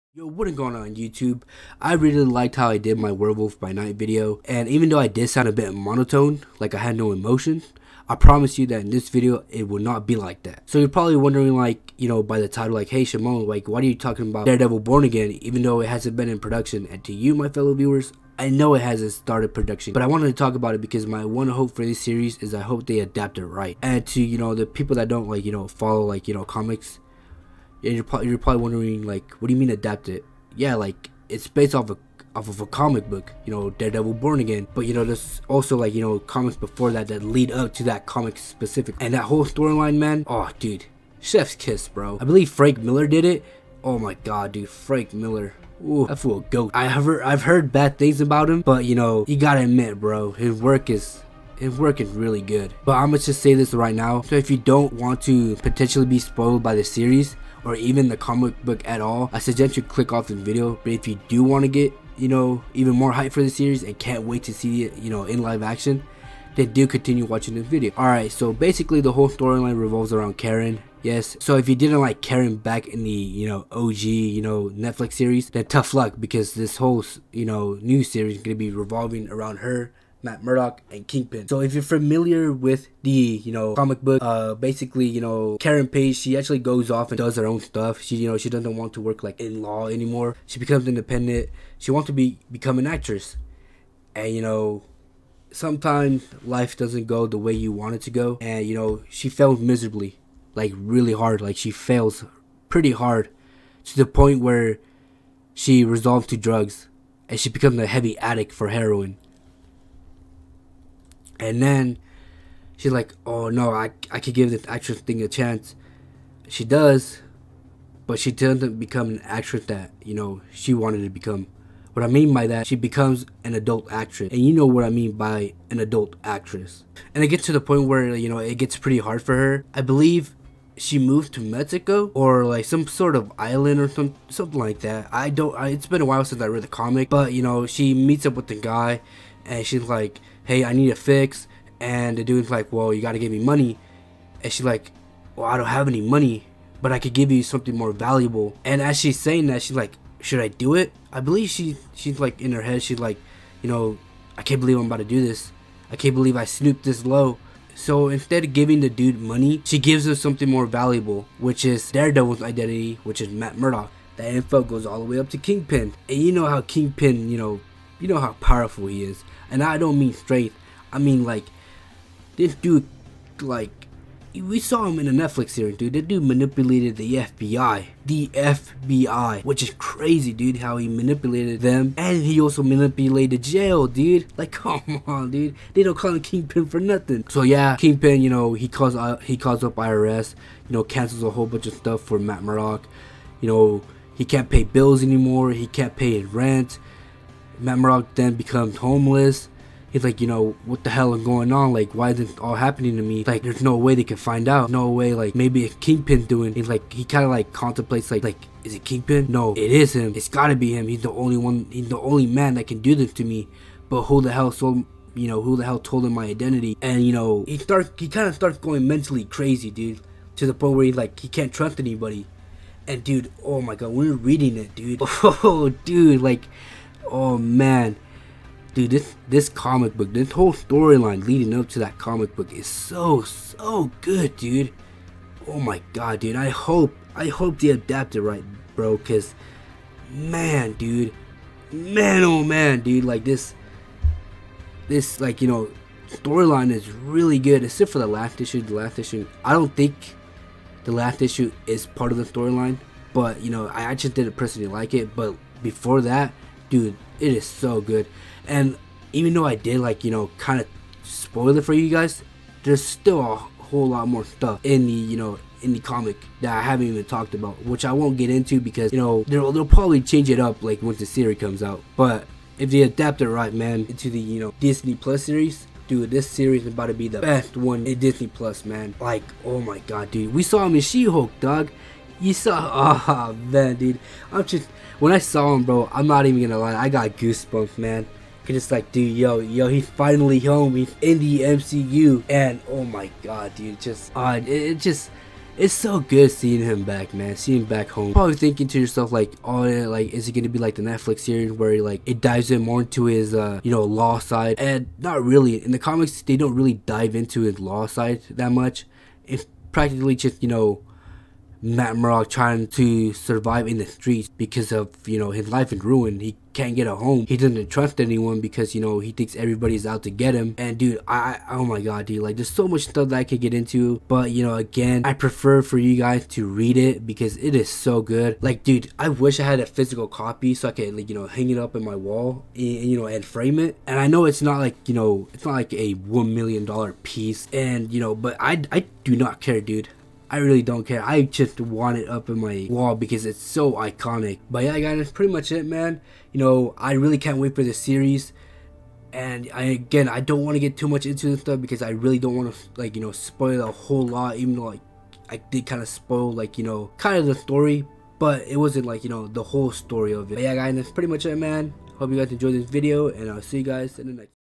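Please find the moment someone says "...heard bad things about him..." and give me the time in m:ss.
0:47.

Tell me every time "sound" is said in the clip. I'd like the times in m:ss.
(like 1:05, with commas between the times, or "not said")
0:05.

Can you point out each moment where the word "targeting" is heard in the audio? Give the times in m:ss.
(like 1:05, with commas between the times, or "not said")
not said.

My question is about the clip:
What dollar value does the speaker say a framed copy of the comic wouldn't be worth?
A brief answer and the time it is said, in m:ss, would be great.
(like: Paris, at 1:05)
$1 million, at 5:35.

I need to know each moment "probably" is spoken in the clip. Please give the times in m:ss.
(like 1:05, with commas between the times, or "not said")
0:10, 0:28, 4:29, 4:58.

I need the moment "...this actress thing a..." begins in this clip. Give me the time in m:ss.
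1:54.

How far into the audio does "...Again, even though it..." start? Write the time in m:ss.
0:15.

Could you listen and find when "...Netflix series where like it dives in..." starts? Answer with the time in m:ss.
5:00.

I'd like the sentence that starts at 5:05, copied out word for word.
In the comics, they don't really dive into his law side that much.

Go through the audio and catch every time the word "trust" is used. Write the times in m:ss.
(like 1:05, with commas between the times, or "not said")
3:41, 5:17.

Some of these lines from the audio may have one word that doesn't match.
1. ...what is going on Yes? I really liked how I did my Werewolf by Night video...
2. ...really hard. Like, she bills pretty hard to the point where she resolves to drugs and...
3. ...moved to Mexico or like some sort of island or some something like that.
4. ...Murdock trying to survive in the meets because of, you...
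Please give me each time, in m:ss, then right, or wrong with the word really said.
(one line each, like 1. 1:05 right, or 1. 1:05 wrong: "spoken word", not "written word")
1. 0:00 wrong: "YouTube", not "Yes"
2. 1:40 wrong: "fails", not "bills"
3. 2:10 right
4. 5:11 wrong: "streets", not "meets".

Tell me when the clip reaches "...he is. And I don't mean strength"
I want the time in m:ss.
2:48.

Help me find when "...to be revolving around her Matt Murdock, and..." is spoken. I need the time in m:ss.
1:18.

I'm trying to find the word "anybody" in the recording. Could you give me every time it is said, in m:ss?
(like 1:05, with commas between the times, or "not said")
3:41.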